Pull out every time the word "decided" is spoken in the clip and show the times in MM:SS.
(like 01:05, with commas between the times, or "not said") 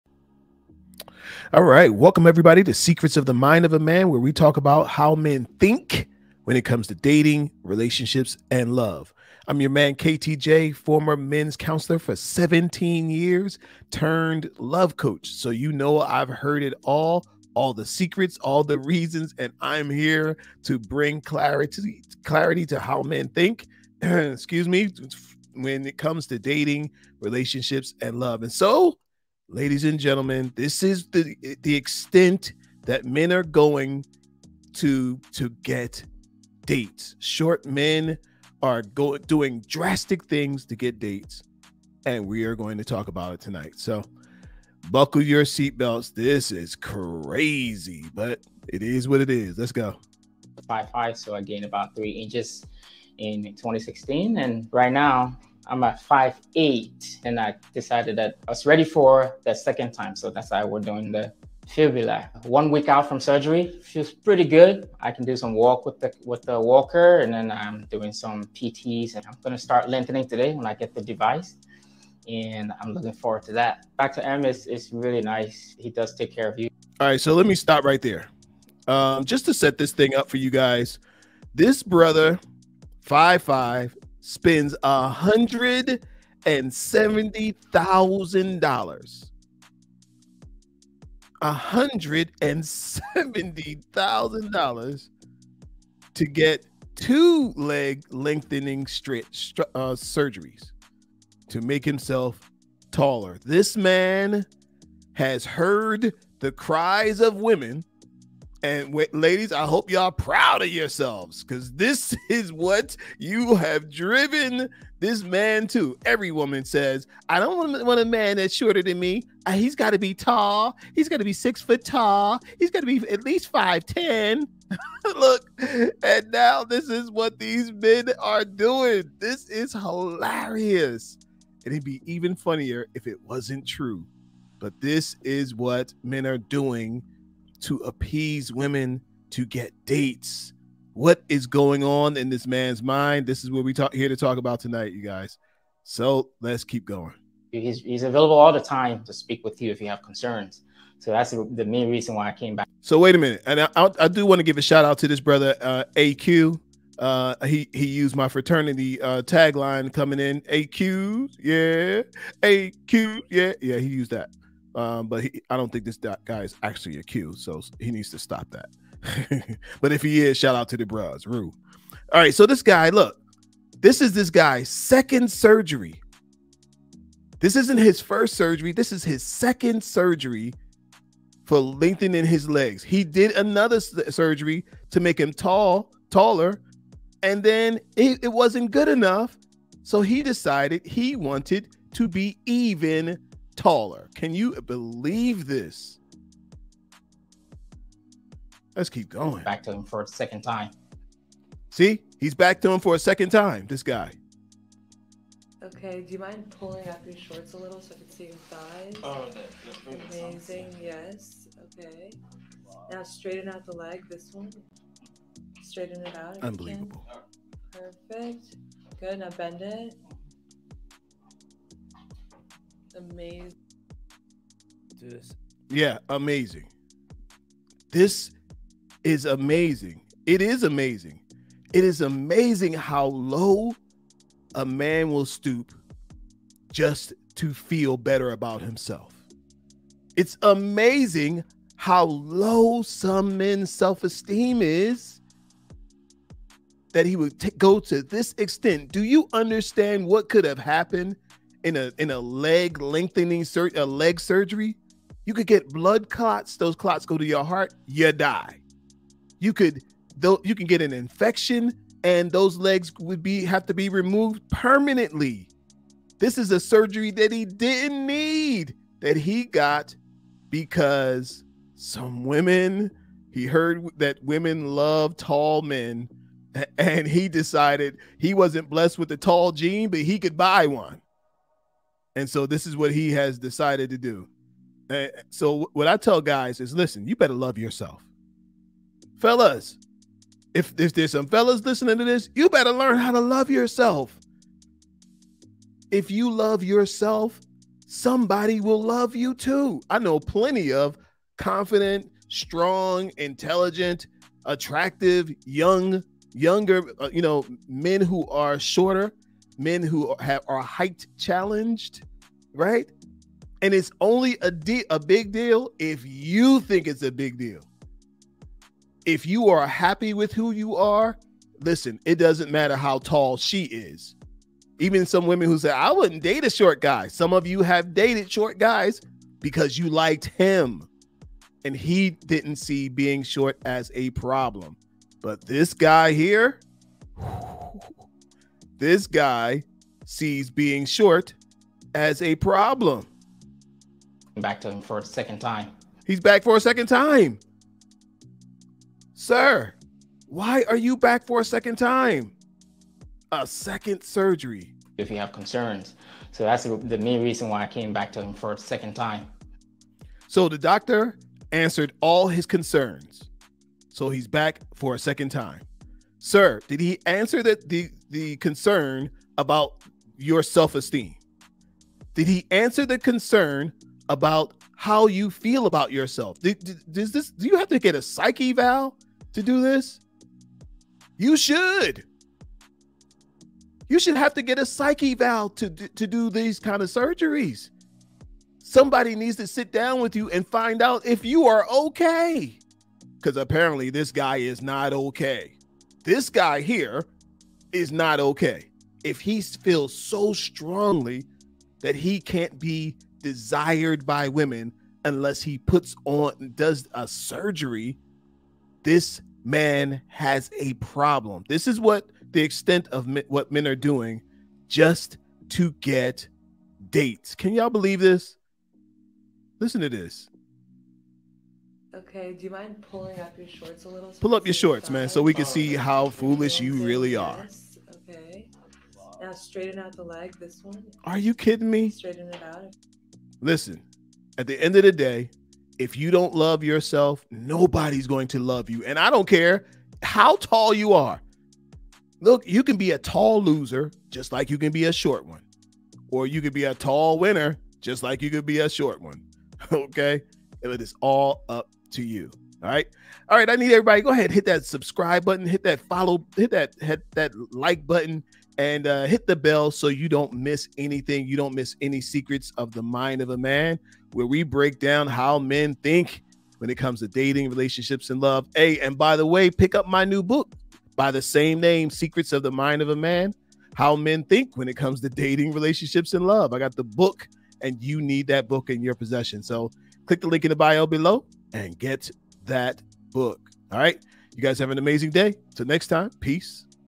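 00:57, 03:10, 04:37, 04:43.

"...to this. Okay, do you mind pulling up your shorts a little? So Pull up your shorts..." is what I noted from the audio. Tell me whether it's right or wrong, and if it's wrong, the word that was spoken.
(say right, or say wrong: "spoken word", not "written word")
right.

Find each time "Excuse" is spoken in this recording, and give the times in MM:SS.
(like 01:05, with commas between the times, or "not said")
00:24.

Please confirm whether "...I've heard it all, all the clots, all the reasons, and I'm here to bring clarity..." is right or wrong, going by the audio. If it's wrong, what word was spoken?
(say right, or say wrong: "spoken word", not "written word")
wrong: "secrets", not "clots".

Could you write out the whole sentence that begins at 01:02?
One week out from surgery, feels pretty good.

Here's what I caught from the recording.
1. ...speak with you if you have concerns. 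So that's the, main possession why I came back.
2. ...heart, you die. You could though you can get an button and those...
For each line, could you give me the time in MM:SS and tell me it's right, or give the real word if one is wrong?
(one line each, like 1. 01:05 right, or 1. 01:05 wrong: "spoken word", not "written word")
1. 02:29 wrong: "reason", not "possession"
2. 04:17 wrong: "infection", not "button".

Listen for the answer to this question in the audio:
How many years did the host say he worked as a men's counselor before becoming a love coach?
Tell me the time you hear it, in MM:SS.
00:12.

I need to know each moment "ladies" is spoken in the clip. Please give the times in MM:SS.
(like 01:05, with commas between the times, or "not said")
00:29, 01:49.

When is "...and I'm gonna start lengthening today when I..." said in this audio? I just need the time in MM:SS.
01:09.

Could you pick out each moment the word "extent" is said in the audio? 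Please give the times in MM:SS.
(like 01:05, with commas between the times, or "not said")
00:31, 04:08, 06:52.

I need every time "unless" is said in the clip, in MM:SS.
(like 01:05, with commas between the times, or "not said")
06:45.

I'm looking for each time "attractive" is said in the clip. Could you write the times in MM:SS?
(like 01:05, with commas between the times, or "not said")
05:04.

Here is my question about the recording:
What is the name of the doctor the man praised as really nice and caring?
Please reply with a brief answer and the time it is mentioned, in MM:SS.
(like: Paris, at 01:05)
Dr. M, at 01:13.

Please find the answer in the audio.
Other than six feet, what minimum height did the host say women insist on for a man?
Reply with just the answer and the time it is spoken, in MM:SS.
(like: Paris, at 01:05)
5'10, at 02:03.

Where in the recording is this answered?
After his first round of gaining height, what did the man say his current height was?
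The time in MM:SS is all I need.
00:56.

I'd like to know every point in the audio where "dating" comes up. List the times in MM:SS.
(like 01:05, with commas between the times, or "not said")
00:06, 00:26, 07:47, 07:55.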